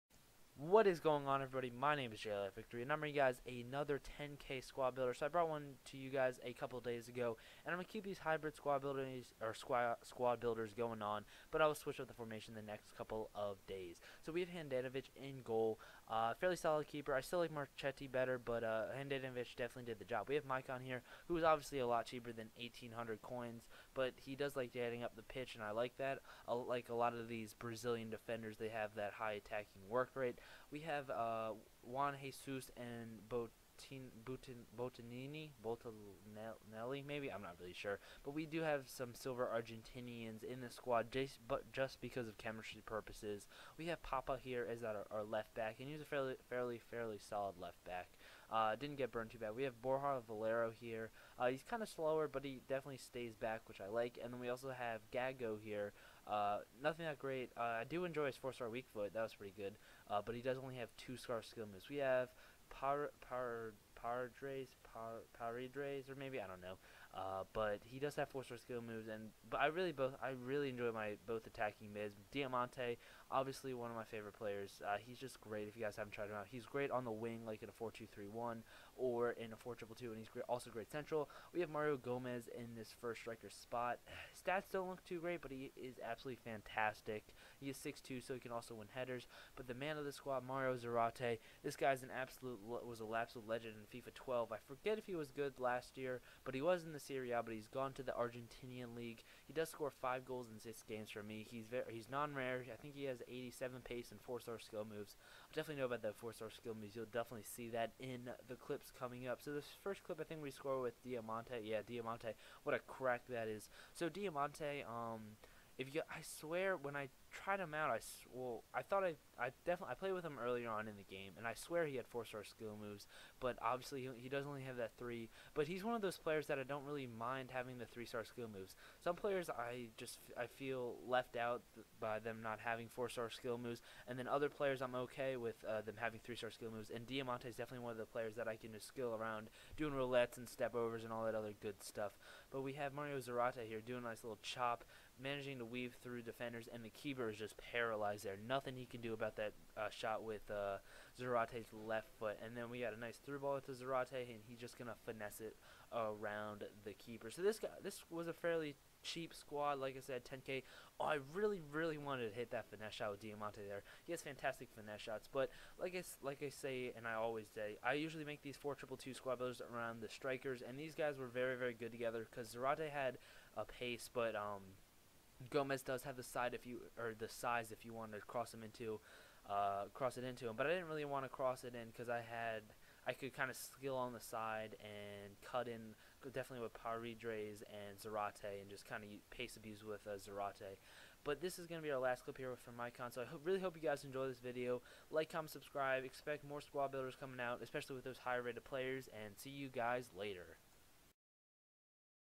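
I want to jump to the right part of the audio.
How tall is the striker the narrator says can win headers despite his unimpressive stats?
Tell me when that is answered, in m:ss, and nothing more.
1:27.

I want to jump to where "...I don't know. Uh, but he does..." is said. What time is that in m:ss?
1:06.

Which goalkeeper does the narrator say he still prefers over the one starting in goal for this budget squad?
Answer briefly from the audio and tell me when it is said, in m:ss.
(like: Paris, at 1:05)
Marchetti, at 0:17.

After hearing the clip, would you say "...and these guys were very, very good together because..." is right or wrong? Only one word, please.
right.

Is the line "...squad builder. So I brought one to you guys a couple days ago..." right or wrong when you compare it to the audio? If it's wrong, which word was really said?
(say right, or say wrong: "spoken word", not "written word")
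right.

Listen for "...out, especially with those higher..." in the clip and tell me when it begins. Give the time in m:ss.
3:17.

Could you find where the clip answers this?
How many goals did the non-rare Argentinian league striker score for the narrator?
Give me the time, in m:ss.
1:40.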